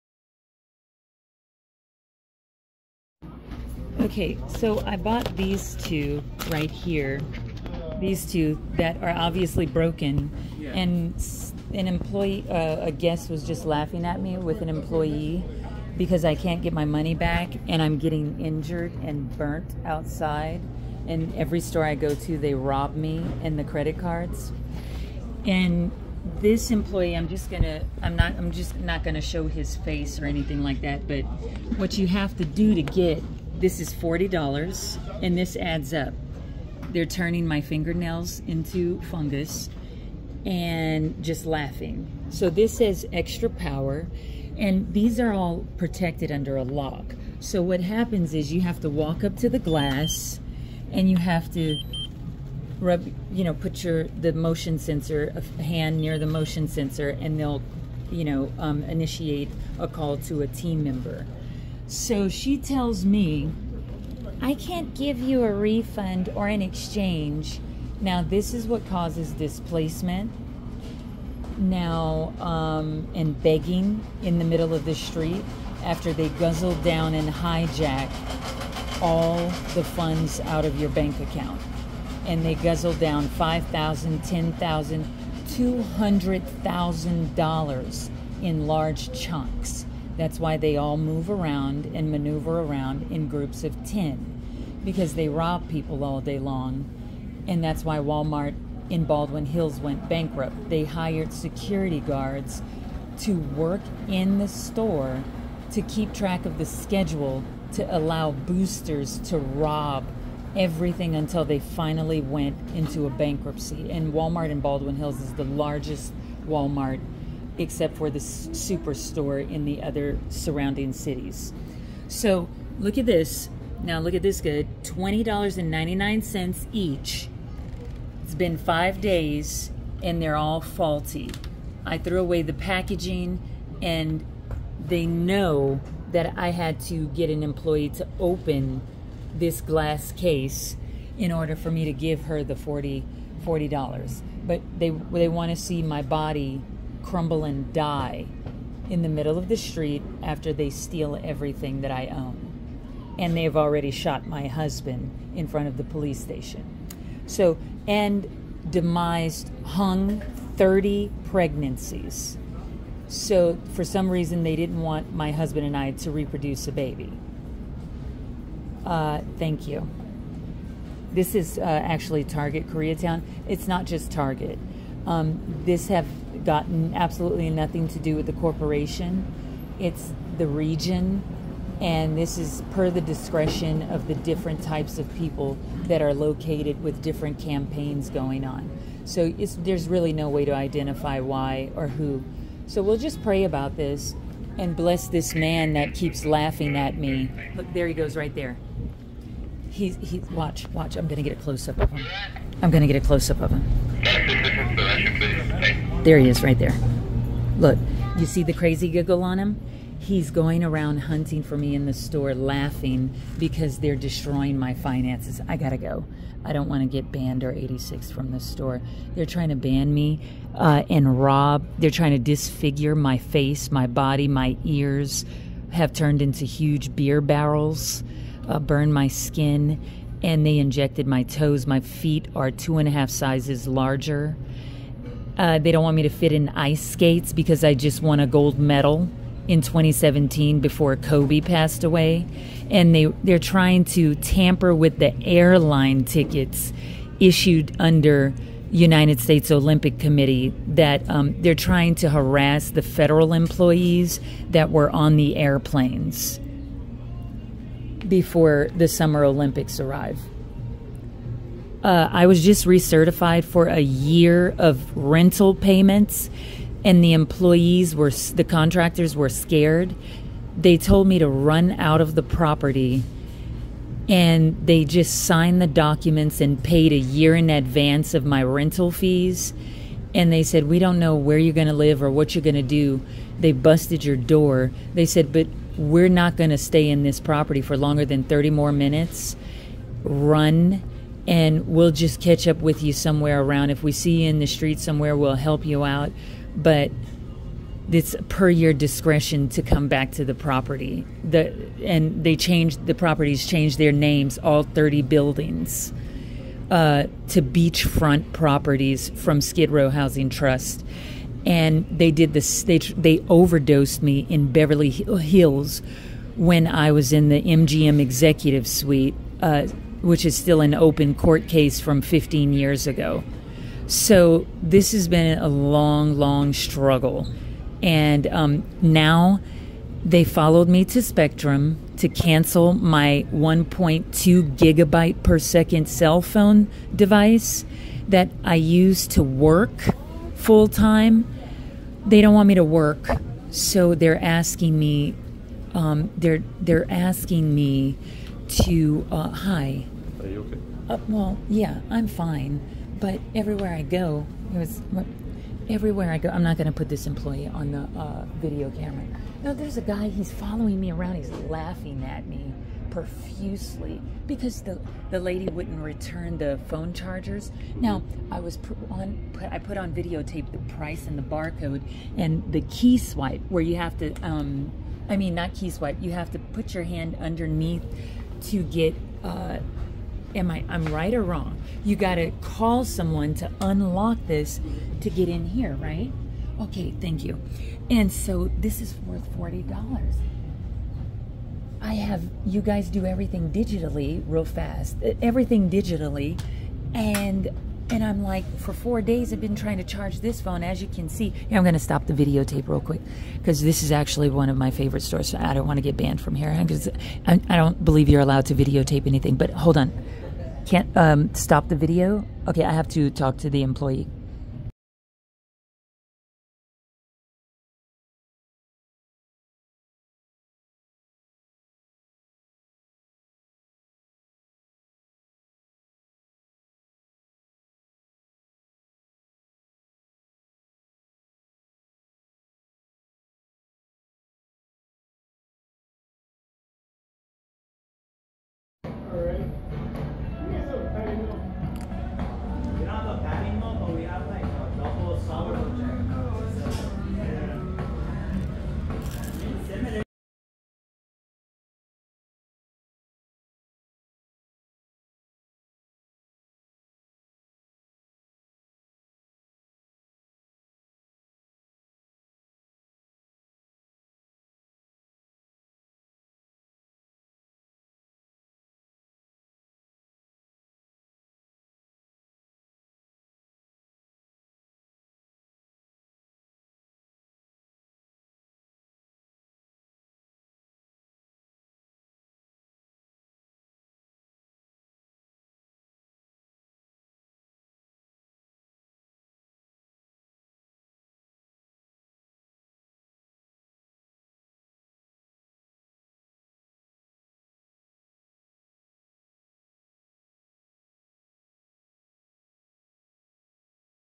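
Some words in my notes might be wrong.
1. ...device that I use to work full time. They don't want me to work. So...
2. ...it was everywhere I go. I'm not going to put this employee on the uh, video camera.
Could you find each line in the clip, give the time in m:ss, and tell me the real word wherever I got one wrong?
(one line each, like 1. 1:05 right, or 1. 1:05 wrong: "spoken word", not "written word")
1. 5:36 right
2. 5:54 right.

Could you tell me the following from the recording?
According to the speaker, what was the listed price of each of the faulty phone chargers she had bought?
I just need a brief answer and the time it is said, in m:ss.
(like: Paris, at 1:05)
$20.99, at 2:04.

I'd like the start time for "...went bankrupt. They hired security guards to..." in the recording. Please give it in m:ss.
1:39.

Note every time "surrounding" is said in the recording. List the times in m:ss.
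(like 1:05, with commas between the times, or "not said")
2:00.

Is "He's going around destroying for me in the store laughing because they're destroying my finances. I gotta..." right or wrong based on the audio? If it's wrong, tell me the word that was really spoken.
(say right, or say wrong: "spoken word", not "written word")
wrong: "hunting", not "destroying".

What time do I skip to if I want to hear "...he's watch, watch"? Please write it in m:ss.
3:20.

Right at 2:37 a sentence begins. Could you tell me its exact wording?
So, and demised, hung 30 pregnancies.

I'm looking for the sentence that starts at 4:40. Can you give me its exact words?
And they said, We don't know where you're going to live or what you're going to do.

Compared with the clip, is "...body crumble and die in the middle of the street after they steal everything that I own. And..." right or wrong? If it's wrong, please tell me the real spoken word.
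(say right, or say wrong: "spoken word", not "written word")
right.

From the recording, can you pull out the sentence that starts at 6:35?
Everything digitally and and I'm like, for four days, I've been trying to charge this phone.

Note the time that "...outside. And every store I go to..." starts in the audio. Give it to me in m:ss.
0:19.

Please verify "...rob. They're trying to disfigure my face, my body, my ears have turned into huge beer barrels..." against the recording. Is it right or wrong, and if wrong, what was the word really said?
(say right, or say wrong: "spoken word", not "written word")
right.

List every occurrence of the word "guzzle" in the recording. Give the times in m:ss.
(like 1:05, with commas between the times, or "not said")
1:16, 1:22.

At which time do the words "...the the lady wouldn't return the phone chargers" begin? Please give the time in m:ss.
6:04.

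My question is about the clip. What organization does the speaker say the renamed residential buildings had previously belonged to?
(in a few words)
Skid Row Housing Trust.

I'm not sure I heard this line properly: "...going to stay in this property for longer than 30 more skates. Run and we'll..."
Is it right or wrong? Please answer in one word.
wrong.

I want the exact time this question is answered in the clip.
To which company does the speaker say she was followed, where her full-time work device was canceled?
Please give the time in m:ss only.
5:31.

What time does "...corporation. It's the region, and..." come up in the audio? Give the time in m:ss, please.
2:58.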